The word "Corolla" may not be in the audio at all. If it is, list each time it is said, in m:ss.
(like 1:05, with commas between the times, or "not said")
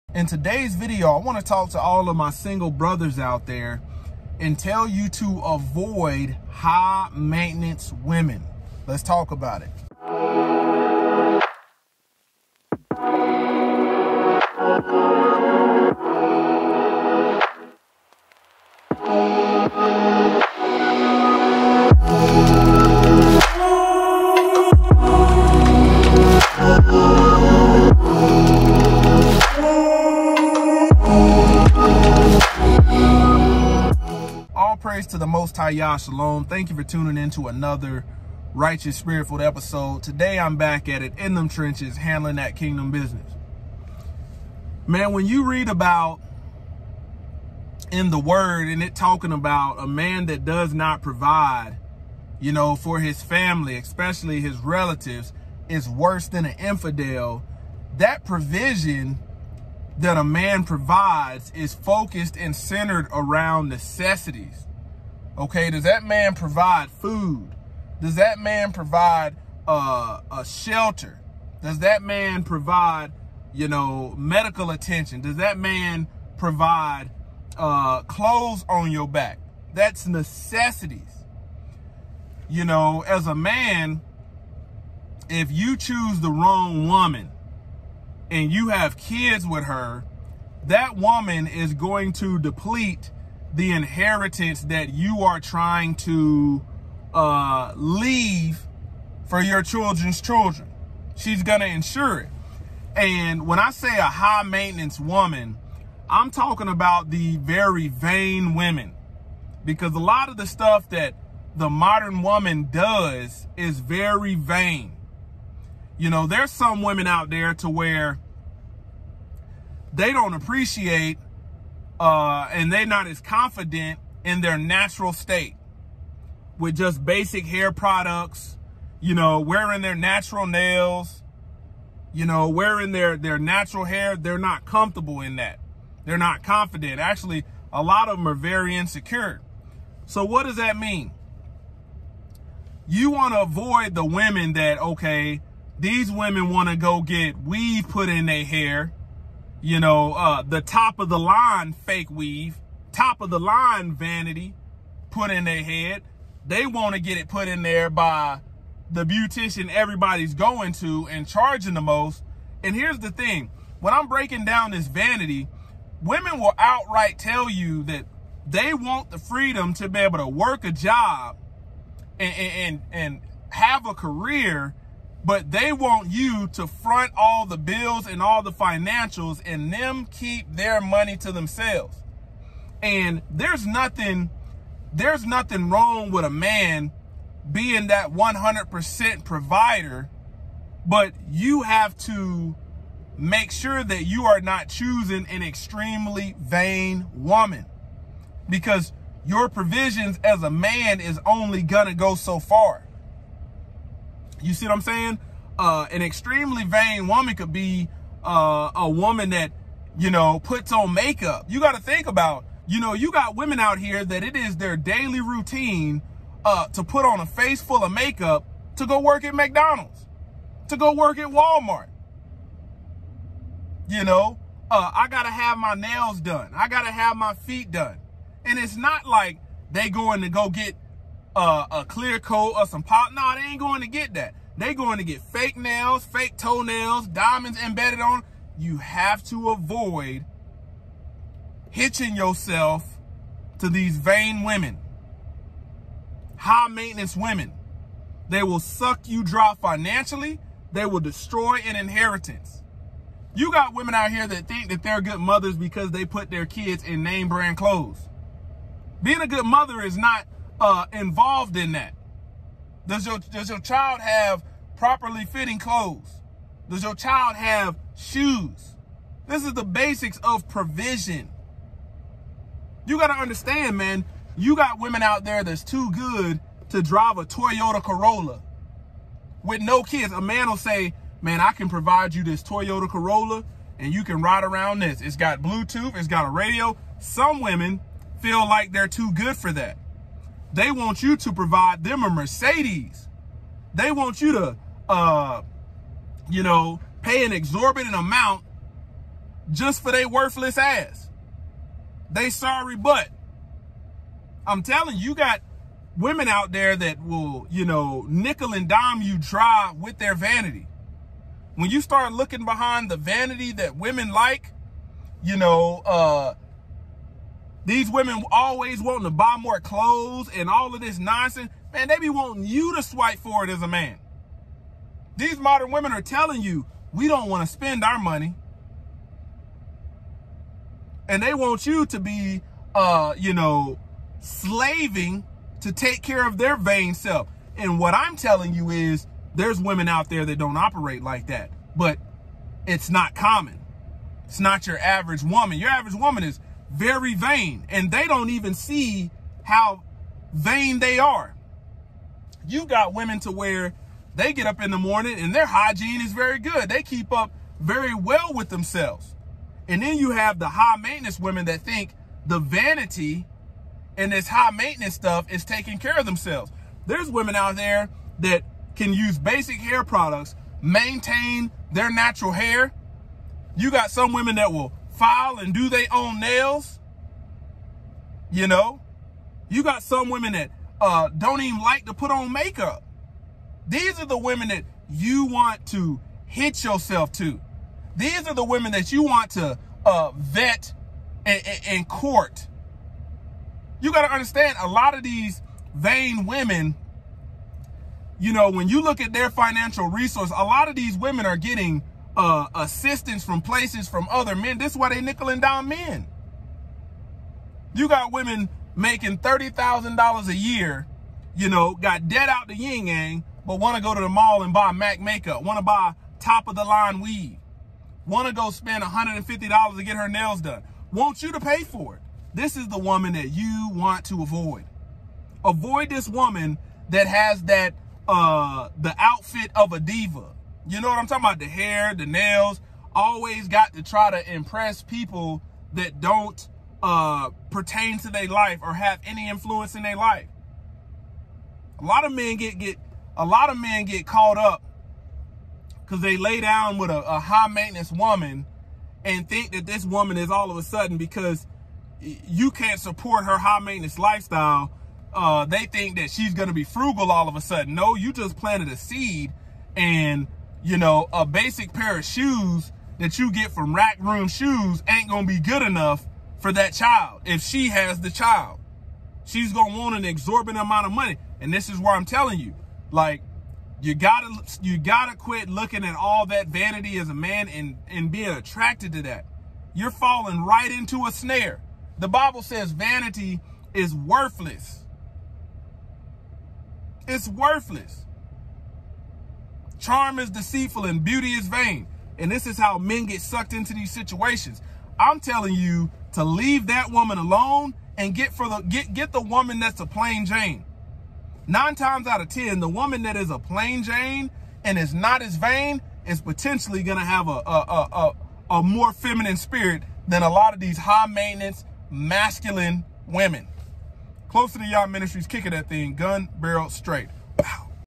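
4:37, 4:42.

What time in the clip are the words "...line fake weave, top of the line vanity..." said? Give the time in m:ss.
2:31.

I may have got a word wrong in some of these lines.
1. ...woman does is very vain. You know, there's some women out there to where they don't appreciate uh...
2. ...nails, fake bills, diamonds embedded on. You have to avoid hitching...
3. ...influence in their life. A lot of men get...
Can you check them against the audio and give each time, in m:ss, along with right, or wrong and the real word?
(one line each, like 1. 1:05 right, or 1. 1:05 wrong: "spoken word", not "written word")
1. 1:52 right
2. 3:55 wrong: "toenails", not "bills"
3. 7:19 right.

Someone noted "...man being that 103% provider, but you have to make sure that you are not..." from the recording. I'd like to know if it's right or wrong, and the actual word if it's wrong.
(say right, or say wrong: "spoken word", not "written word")
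wrong: "100", not "103".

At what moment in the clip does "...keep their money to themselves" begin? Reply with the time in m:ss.
3:00.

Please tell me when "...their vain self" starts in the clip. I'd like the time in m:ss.
5:36.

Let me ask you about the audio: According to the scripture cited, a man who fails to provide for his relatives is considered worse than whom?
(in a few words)
an infidel.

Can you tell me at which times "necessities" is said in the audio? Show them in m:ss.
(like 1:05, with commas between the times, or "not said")
1:03, 1:20.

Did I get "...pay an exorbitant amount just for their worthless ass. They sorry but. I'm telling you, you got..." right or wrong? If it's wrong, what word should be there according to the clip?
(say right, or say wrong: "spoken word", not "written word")
right.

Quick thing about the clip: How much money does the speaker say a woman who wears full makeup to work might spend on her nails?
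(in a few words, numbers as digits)
$150.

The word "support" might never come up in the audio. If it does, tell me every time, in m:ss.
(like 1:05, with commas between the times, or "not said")
7:32.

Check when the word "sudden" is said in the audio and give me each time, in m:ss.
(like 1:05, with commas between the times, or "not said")
7:30, 7:37.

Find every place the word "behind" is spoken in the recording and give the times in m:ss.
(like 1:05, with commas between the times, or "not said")
5:12.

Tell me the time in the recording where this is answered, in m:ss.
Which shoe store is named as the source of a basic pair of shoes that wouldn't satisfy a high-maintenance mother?
7:43.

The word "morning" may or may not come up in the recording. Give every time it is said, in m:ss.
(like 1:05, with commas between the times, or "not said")
5:54.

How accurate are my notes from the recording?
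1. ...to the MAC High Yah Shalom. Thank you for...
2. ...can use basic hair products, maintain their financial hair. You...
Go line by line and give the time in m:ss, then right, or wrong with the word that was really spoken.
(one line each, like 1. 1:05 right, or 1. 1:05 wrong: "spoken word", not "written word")
1. 0:35 wrong: "Most", not "MAC"
2. 6:08 wrong: "natural", not "financial".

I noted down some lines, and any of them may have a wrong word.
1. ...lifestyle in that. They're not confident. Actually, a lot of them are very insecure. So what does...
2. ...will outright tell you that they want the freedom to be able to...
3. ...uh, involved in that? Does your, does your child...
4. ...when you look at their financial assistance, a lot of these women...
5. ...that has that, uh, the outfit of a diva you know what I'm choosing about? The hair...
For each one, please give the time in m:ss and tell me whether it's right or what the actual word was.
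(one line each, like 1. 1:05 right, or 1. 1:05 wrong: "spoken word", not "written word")
1. 2:14 wrong: "comfortable", not "lifestyle"
2. 2:46 right
3. 4:20 right
4. 6:38 wrong: "resource", not "assistance"
5. 7:06 wrong: "talking", not "choosing".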